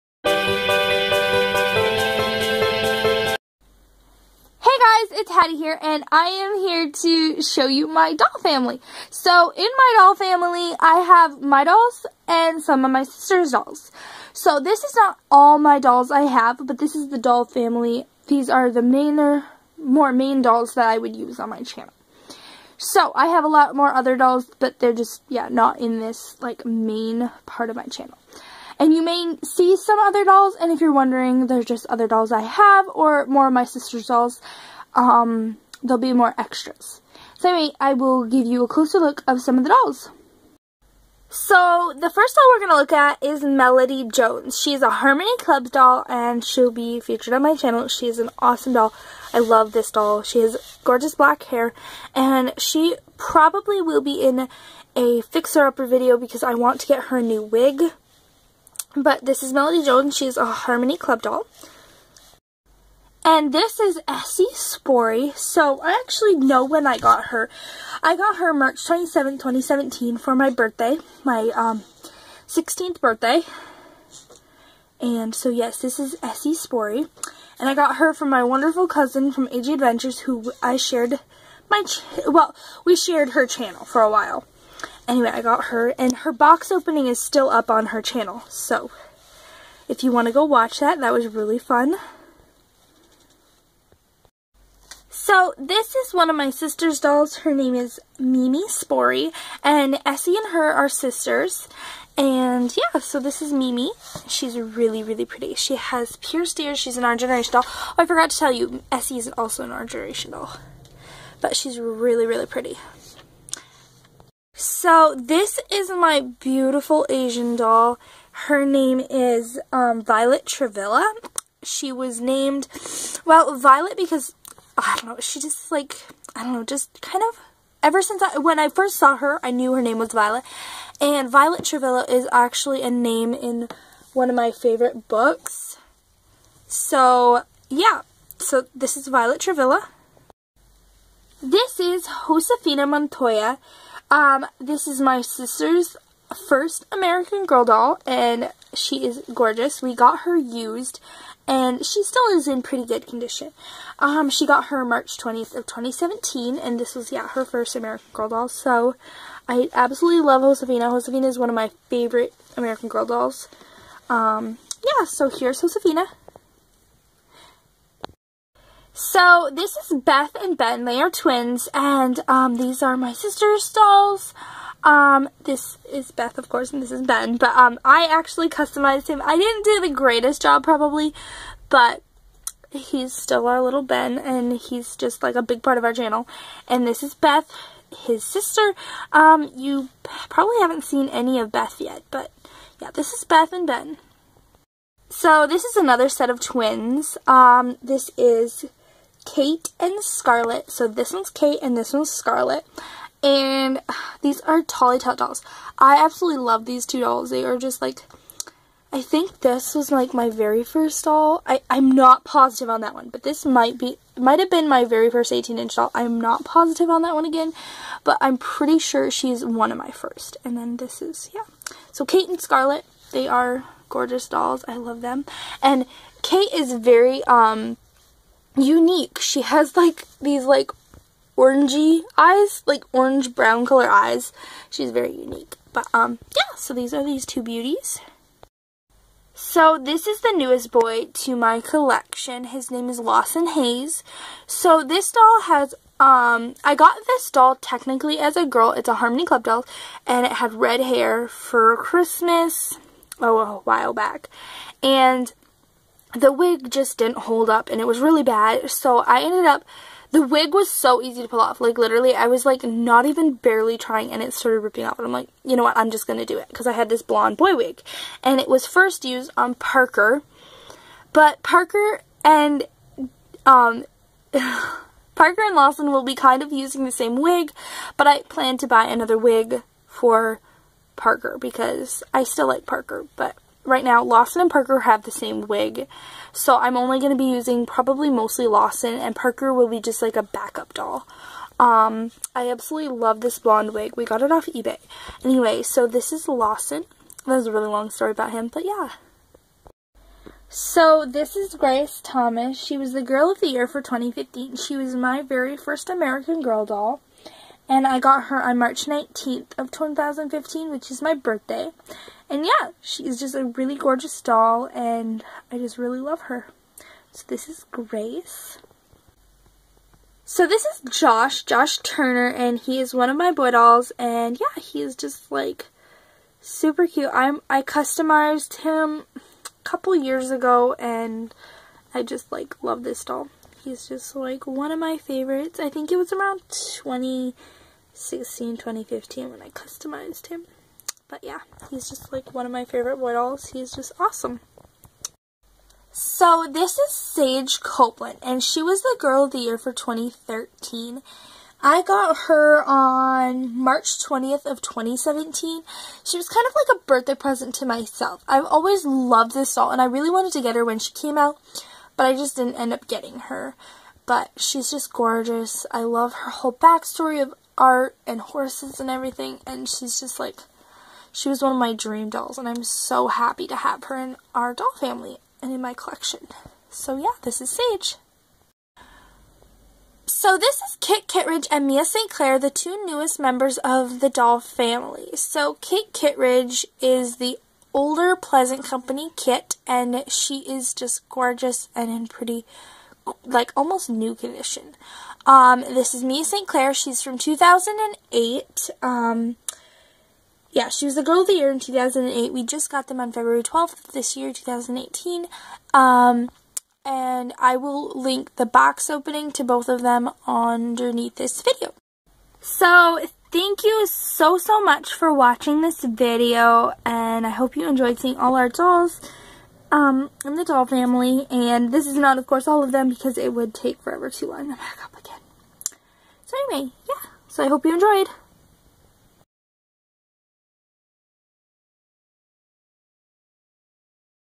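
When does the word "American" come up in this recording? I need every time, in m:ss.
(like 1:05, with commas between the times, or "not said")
2:26, 2:37, 2:42, 5:05.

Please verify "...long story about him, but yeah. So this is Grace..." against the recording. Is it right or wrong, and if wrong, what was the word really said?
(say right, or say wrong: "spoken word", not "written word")
right.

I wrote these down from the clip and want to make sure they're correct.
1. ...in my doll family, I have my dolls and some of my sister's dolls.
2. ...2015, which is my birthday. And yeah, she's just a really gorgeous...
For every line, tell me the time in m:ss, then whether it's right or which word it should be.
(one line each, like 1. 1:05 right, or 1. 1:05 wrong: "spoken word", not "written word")
1. 0:09 right
2. 5:09 right.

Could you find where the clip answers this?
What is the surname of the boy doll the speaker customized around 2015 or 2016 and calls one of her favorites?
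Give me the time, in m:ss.
5:21.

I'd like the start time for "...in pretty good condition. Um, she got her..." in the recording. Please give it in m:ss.
2:32.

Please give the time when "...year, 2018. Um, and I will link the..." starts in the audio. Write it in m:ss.
6:44.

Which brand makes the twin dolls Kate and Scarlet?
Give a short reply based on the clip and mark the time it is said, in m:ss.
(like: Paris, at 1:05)
Tolly Tot, at 3:24.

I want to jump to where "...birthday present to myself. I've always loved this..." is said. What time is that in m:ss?
5:56.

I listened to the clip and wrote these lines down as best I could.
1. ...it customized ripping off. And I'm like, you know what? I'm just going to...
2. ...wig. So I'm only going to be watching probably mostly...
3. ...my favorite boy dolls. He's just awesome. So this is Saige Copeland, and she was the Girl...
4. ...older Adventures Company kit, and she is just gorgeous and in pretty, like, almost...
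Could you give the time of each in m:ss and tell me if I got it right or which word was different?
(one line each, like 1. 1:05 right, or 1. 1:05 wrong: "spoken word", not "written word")
1. 4:24 wrong: "started", not "customized"
2. 4:45 wrong: "using", not "watching"
3. 5:42 right
4. 6:27 wrong: "Pleasant", not "Adventures".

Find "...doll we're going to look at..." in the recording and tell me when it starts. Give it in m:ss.
0:42.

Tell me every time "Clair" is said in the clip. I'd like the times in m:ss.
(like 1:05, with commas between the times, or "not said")
6:22, 6:36.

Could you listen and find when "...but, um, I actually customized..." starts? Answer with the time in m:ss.
2:57.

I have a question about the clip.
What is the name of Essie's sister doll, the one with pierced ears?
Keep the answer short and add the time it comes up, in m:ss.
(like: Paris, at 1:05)
Mimi Spory, at 1:38.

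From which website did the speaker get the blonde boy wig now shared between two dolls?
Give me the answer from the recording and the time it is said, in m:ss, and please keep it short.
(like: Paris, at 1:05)
eBay, at 4:54.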